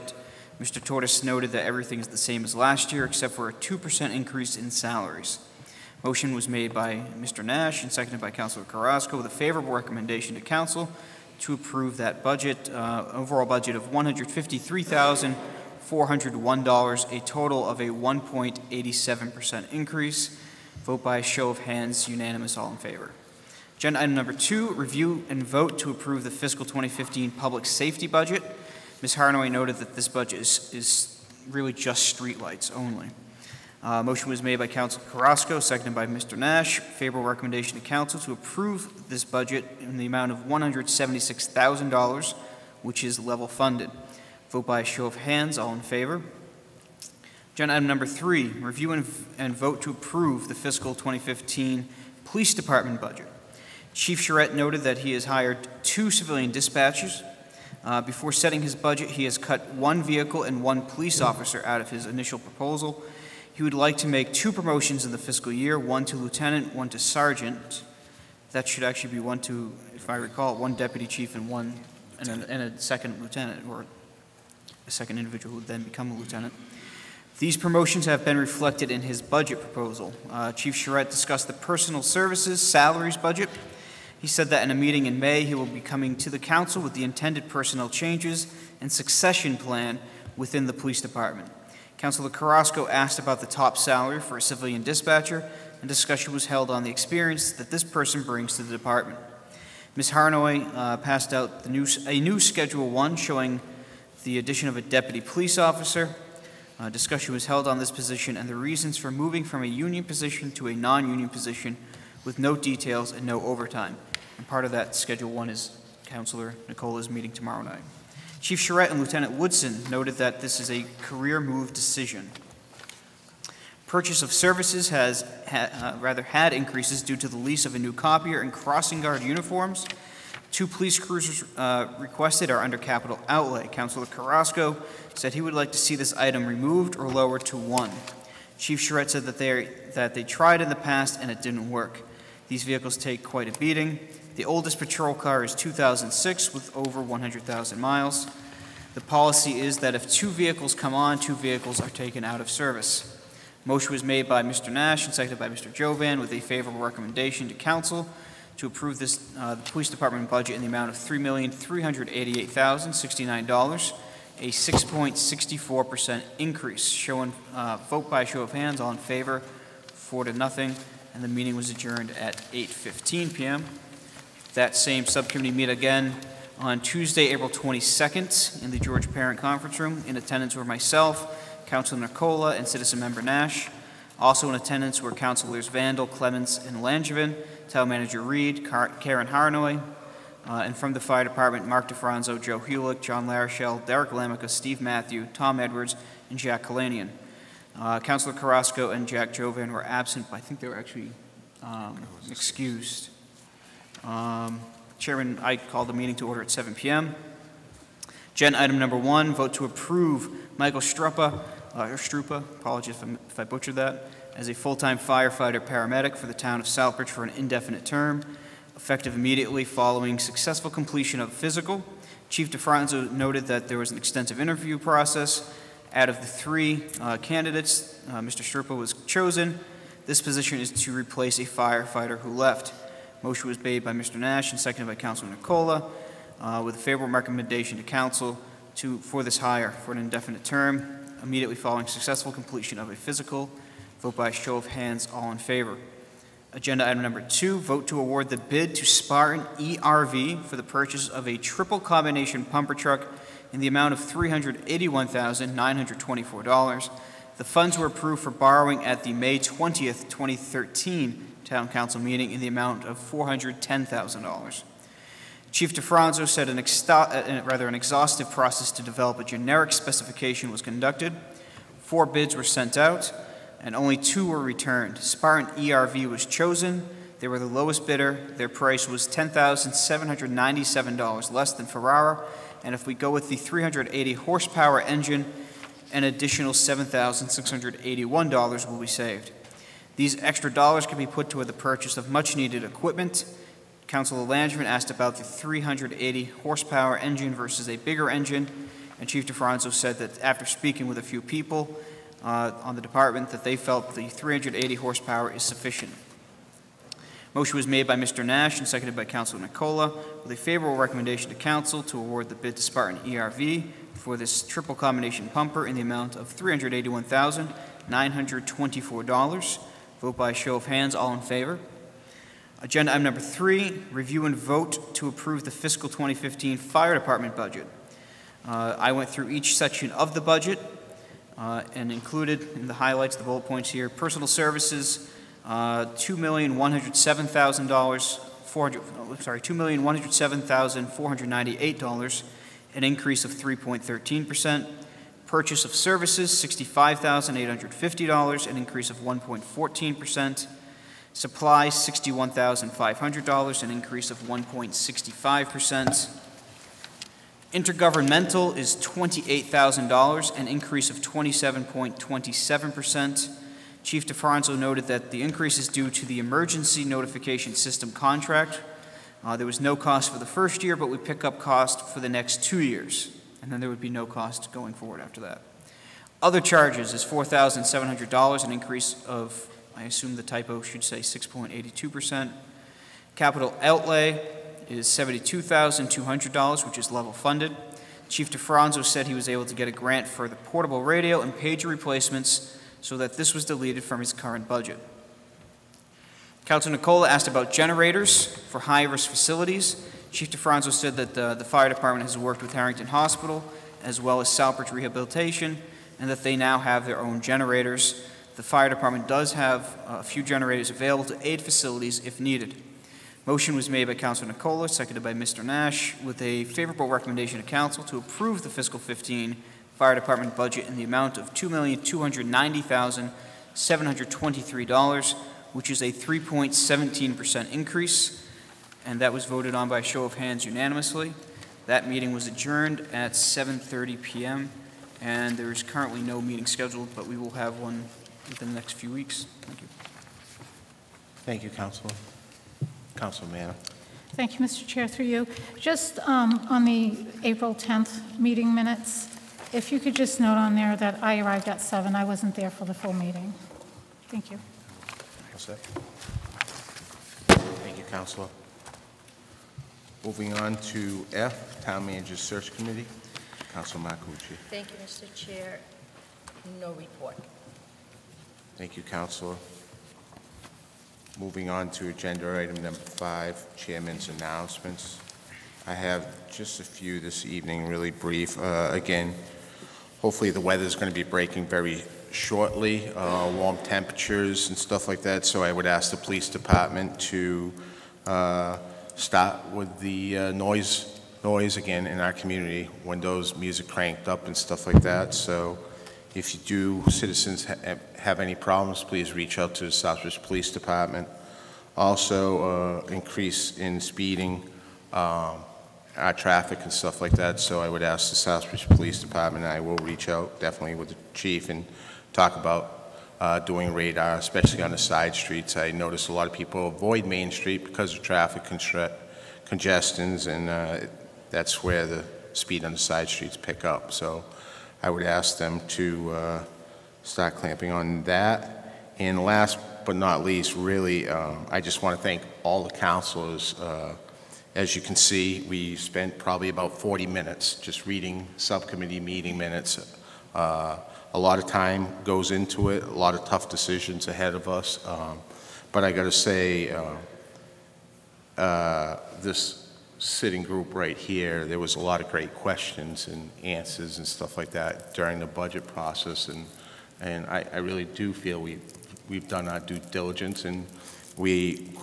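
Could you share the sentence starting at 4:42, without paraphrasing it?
And if we go with the 380 horsepower engine, an additional $7,681 will be saved.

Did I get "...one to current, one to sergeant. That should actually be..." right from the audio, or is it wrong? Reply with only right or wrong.
wrong.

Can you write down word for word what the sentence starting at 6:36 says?
Councilor Nicola asked about generators for high-risk facilities.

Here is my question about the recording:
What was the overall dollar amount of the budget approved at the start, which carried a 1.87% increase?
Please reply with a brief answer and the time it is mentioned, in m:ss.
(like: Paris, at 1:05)
$153,401, at 0:13.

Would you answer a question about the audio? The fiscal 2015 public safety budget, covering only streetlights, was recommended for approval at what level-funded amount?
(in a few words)
$176,000.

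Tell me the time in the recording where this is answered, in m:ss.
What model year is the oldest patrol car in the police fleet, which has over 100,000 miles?
2:25.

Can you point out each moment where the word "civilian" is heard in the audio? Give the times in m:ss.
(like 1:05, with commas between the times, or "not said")
0:56, 1:34.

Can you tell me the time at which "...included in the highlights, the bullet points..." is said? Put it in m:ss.
5:31.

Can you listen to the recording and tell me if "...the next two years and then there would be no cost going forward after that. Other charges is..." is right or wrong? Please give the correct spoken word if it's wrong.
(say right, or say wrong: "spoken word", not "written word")
right.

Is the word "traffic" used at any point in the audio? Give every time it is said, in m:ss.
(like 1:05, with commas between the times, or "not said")
8:26, 8:38.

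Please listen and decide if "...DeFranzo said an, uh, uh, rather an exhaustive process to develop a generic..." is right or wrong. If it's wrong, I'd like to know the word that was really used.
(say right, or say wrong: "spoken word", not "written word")
right.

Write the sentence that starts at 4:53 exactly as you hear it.
Councilor Langevin asked about the 380 horsepower engine versus a bigger engine.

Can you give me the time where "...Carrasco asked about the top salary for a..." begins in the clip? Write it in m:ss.
1:32.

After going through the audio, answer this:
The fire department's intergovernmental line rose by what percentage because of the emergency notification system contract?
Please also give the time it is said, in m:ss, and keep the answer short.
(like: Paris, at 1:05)
27.27%, at 6:00.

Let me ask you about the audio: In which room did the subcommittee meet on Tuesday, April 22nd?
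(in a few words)
George Parent Conference Room.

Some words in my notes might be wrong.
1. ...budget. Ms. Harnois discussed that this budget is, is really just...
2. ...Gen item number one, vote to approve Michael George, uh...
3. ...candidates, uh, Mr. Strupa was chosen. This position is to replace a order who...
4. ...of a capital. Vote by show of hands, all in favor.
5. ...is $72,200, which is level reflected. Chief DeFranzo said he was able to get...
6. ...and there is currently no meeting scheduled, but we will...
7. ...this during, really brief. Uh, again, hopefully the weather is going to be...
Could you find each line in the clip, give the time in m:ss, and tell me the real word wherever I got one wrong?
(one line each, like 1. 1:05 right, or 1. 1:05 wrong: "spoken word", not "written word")
1. 0:28 wrong: "noted", not "discussed"
2. 3:28 wrong: "Struppa", not "George"
3. 3:47 wrong: "firefighter", not "order"
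4. 4:02 wrong: "physical", not "capital"
5. 6:24 wrong: "funded", not "reflected"
6. 7:15 right
7. 7:57 wrong: "evening", not "during".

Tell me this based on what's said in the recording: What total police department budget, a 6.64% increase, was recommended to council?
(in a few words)
$3,388,069.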